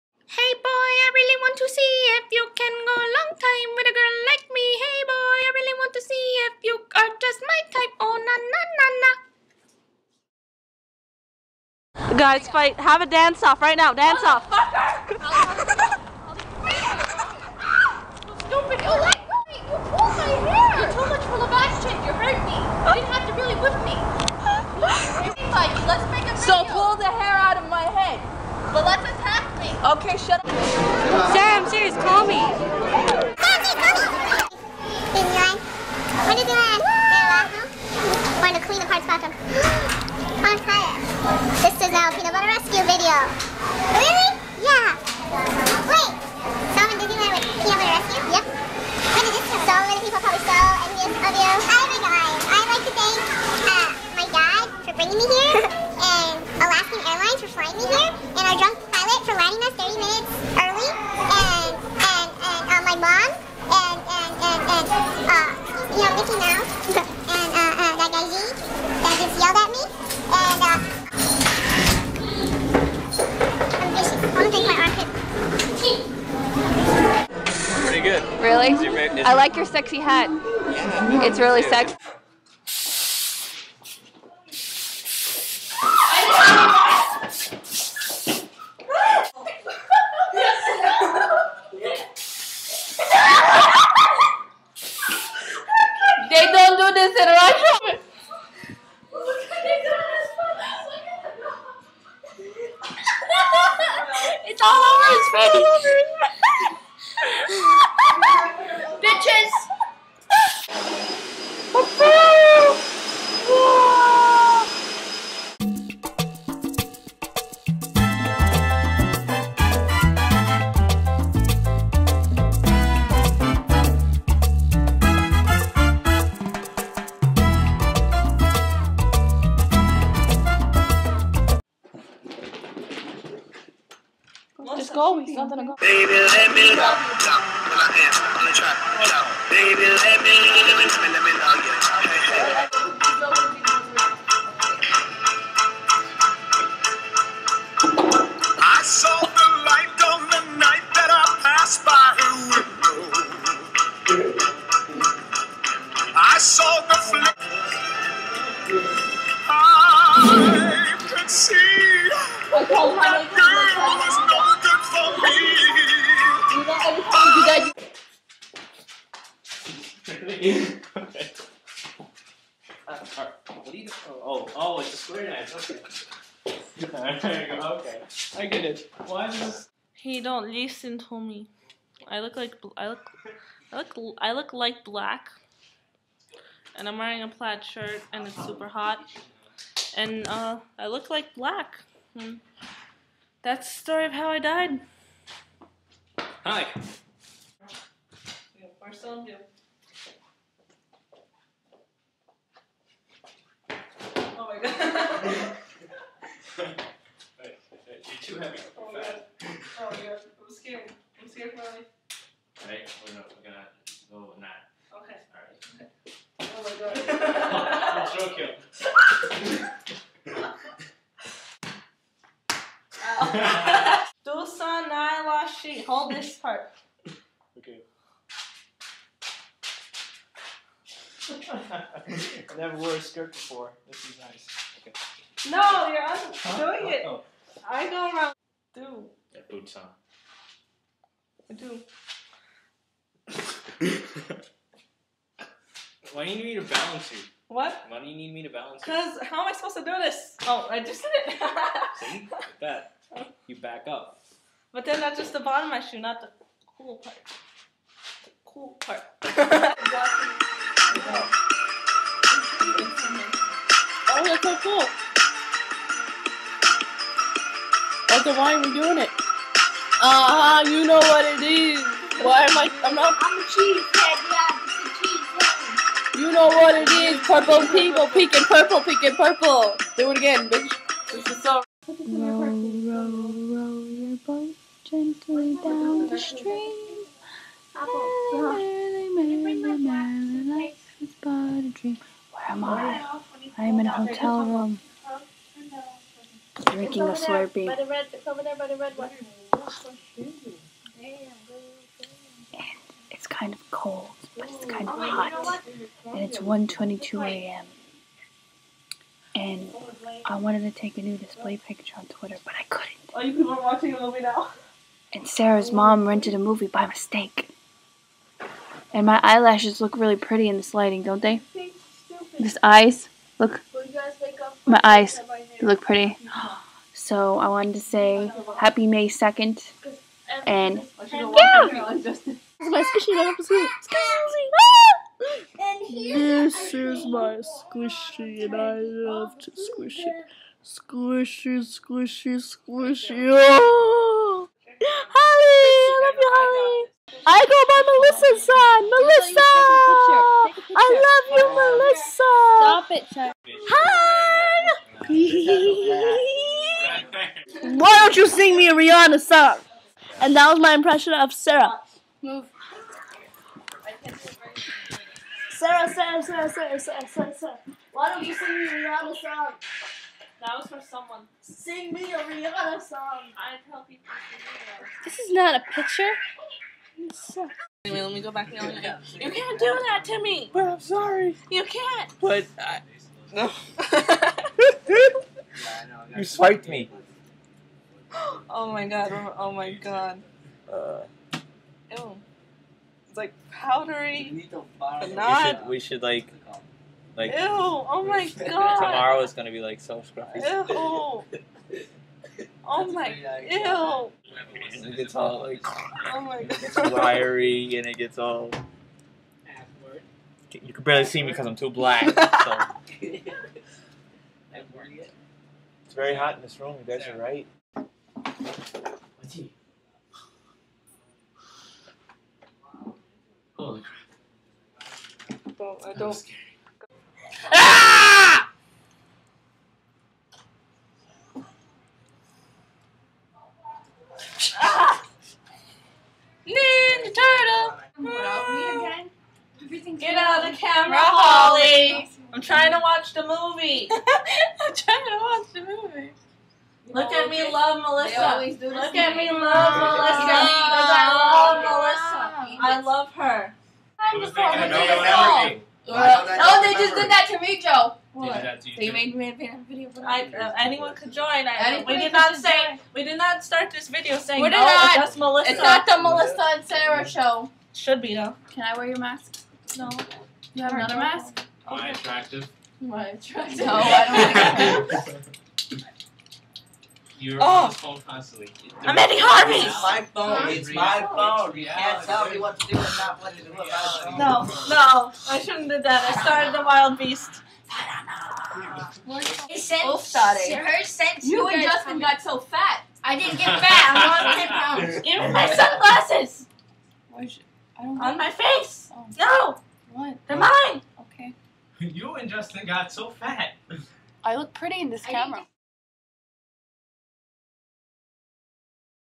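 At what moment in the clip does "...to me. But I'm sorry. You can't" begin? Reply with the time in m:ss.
6:20.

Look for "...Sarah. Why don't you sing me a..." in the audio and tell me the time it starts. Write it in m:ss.
6:07.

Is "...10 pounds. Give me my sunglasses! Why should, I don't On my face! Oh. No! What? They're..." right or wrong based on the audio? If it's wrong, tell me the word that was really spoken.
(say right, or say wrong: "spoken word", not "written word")
right.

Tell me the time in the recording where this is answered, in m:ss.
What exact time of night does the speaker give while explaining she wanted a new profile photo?
5:06.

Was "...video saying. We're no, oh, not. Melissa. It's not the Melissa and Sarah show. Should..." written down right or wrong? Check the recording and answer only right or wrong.
right.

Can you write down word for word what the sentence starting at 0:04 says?
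Hey boy, I really want to see if you are just my type.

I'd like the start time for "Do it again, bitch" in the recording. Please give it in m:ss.
4:39.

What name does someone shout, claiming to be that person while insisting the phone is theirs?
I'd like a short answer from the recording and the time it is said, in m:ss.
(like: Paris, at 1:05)
Eddie Harvey, at 7:58.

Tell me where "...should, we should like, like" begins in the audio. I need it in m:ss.
6:35.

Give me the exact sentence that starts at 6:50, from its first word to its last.
You can barely see me because I'm too black.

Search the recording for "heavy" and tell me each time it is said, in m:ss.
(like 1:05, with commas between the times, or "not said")
3:28.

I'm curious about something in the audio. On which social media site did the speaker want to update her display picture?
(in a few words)
Twitter.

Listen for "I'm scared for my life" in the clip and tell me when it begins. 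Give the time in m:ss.
3:31.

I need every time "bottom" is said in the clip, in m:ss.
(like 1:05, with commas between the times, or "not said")
4:15.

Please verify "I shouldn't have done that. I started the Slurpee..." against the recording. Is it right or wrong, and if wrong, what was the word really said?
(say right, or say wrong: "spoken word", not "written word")
wrong: "Wild", not "Slurpee".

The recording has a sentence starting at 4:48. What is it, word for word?
Merrily, merrily, merrily, life is but a dream.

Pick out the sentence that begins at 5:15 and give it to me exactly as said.
And Sarah's mom rented a movie by mistake.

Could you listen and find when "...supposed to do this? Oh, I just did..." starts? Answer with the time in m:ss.
4:09.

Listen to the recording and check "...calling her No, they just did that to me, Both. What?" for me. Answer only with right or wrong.
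wrong.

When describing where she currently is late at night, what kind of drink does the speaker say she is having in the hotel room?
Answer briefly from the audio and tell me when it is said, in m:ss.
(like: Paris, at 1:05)
Slurpee, at 4:57.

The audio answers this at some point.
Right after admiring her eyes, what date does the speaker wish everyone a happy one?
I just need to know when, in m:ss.
5:28.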